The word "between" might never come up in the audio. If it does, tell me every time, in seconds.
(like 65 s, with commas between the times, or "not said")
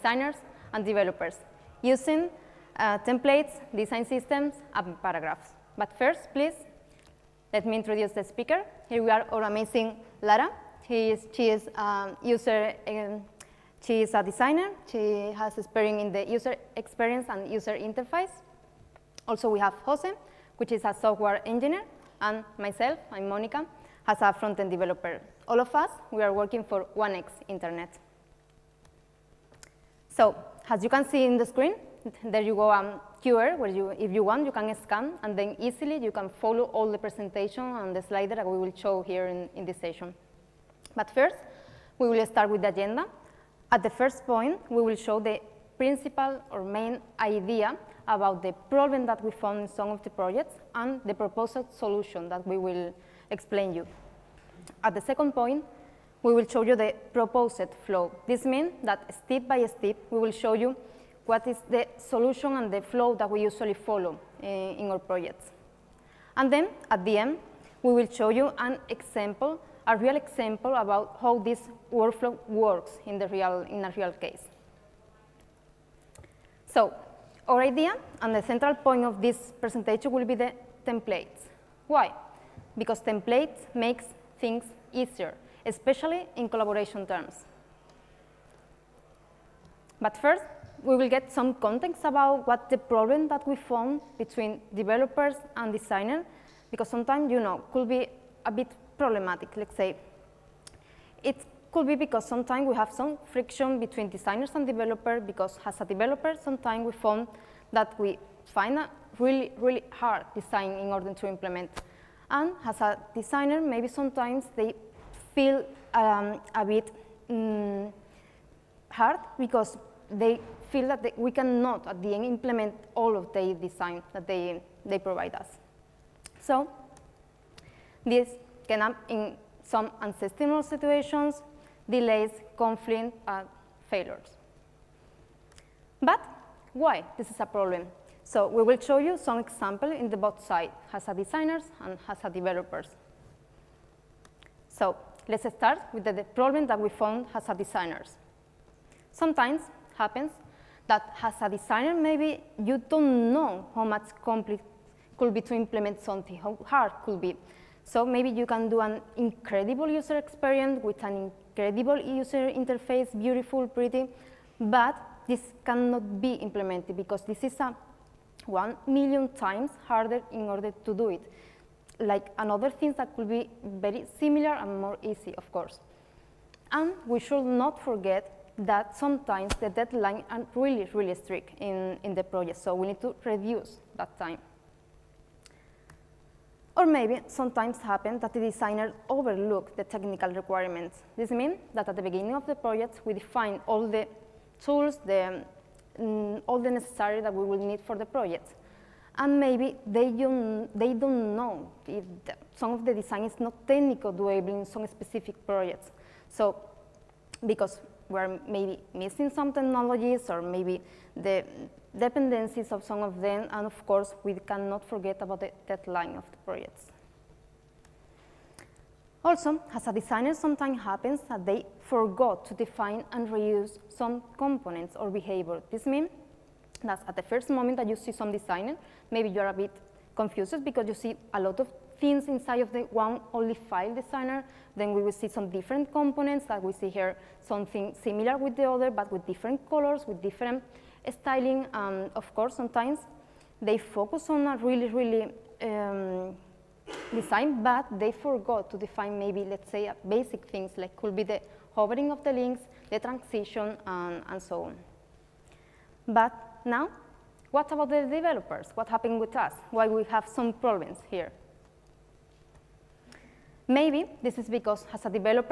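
94 s, 103 s.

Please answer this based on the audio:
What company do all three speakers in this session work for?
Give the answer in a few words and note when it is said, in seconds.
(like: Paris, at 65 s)
OneX Internet, at 26 s.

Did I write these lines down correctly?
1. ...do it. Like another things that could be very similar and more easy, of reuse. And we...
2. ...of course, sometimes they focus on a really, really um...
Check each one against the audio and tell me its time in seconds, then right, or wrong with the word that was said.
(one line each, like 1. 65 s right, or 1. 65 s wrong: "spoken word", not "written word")
1. 170 s wrong: "course", not "reuse"
2. 242 s right.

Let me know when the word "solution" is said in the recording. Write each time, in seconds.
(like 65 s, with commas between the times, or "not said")
51 s, 61 s.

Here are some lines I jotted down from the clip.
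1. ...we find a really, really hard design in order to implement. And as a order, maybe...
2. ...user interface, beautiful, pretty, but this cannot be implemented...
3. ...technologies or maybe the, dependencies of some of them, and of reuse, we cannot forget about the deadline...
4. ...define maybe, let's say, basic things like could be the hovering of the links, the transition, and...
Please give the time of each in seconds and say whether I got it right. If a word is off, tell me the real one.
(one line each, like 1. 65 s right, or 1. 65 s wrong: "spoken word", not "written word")
1. 107 s wrong: "designer", not "order"
2. 161 s right
3. 209 s wrong: "course", not "reuse"
4. 248 s right.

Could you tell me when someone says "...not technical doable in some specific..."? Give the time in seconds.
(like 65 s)
203 s.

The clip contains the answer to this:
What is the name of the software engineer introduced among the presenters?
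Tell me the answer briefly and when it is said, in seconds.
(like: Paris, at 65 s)
Jose, at 19 s.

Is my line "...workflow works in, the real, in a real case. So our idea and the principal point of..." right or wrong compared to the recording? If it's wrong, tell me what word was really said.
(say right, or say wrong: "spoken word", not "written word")
wrong: "central", not "principal".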